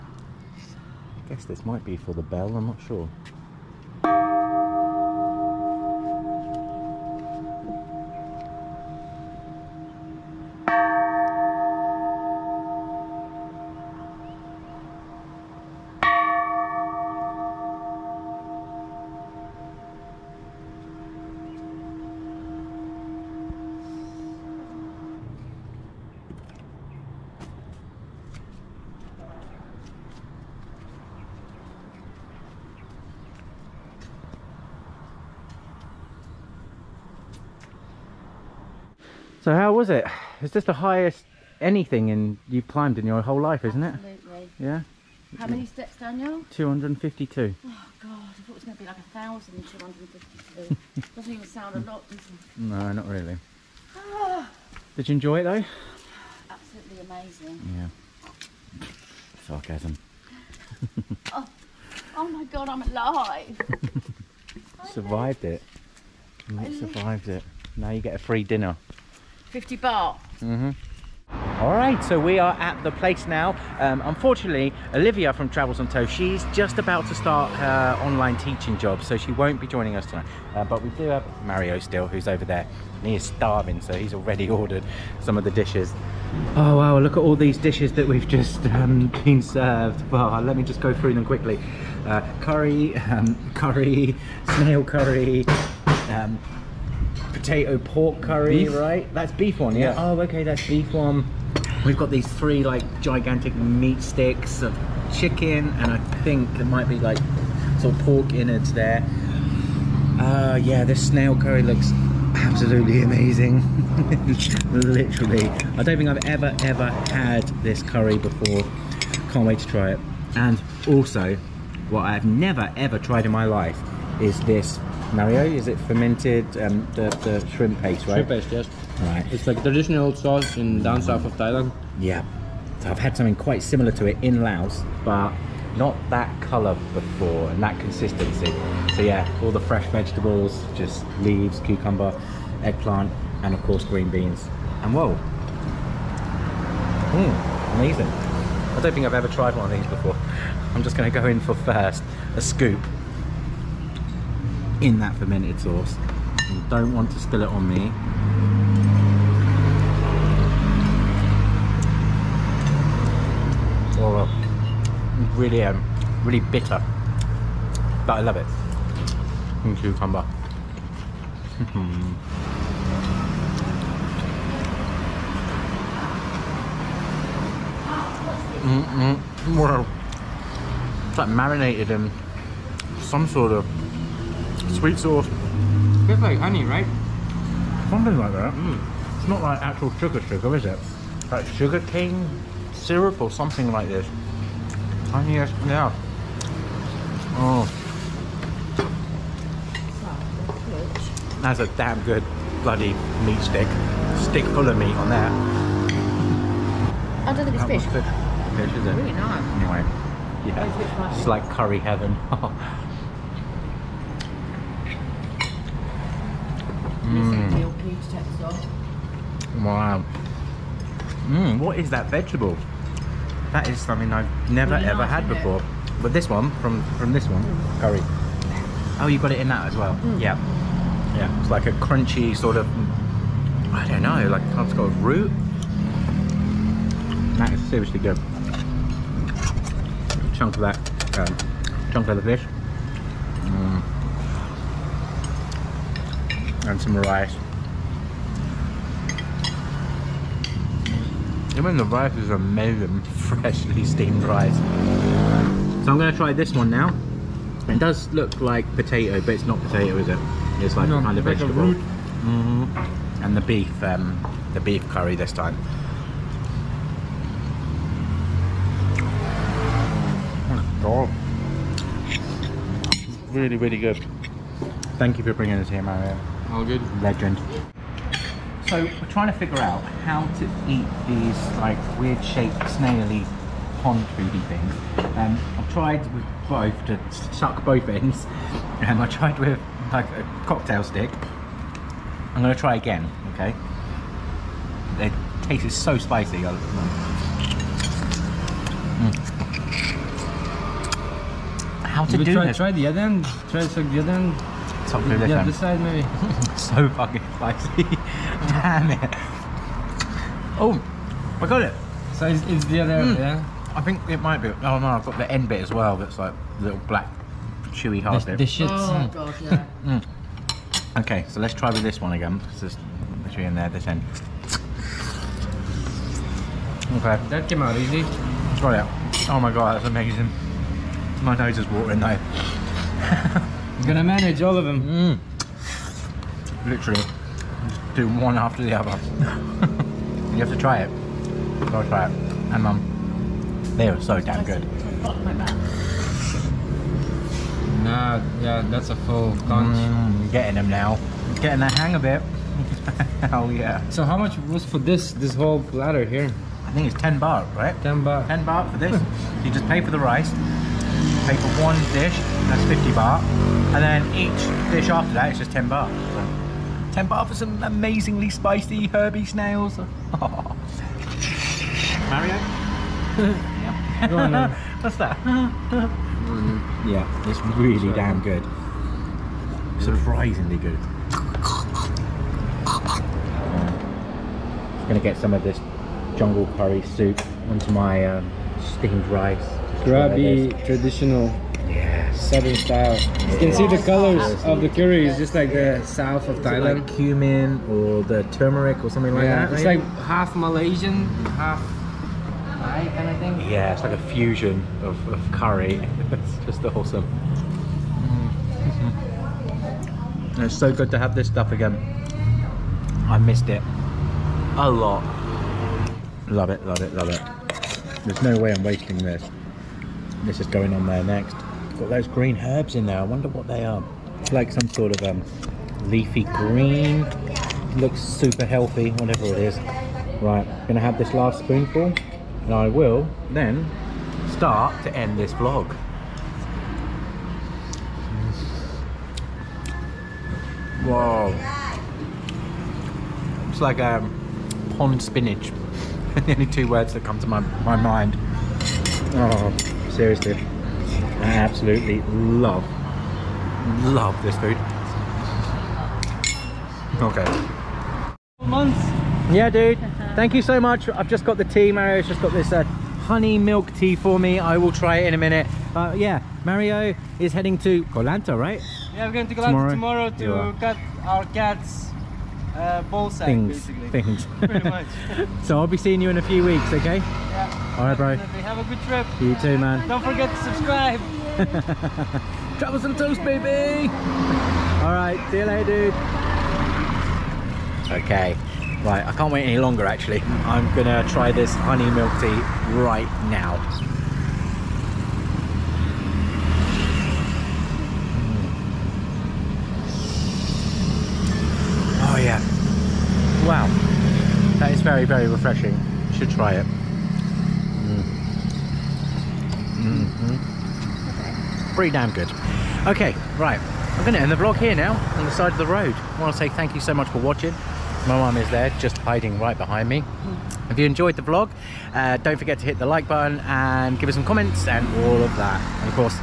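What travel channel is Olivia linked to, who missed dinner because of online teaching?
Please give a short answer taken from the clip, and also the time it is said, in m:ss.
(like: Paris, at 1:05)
Travels on Toe, at 1:15.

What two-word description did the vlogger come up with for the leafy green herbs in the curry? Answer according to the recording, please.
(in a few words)
Pond spinach.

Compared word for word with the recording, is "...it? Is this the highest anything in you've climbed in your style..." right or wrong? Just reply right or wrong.
wrong.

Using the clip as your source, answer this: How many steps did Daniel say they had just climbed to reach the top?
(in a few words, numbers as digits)
252.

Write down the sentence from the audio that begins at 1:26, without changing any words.
Oh, wow, look at all these dishes that we've just um, been served.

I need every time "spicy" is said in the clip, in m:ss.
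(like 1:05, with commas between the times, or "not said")
4:55, 5:07, 6:08.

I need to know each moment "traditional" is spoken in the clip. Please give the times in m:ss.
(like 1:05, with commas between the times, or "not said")
2:09, 6:30.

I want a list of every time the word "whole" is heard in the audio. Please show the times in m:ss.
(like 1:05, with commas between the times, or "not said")
0:43, 5:55.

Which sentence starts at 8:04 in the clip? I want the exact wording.
All right, see you later, dude.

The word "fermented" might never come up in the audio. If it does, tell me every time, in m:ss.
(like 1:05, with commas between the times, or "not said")
2:05, 2:35.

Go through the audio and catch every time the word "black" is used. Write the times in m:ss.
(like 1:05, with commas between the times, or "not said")
5:16.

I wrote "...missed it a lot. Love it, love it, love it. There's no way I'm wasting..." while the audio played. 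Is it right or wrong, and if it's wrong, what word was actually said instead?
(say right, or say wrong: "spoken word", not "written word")
right.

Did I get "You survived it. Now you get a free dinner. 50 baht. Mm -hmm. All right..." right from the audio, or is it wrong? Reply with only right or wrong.
right.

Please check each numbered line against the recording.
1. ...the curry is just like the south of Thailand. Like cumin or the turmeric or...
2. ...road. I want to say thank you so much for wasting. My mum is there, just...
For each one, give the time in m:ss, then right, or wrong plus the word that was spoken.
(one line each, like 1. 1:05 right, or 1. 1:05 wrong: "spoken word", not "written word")
1. 6:34 right
2. 8:35 wrong: "watching", not "wasting".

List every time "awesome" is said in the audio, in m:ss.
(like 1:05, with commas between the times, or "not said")
6:46.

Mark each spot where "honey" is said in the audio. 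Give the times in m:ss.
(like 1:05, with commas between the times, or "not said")
3:06, 3:15, 7:42, 8:11.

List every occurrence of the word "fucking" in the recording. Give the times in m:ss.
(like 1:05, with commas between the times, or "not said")
5:06.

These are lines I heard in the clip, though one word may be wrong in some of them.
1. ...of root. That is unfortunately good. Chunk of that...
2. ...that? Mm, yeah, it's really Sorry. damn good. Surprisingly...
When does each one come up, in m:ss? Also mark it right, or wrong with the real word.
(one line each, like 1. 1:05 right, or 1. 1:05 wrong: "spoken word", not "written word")
1. 3:54 wrong: "seriously", not "unfortunately"
2. 6:14 right.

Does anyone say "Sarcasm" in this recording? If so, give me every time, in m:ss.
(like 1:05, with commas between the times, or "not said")
0:59.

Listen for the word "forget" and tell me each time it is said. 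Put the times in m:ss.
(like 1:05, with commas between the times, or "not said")
8:00, 8:42.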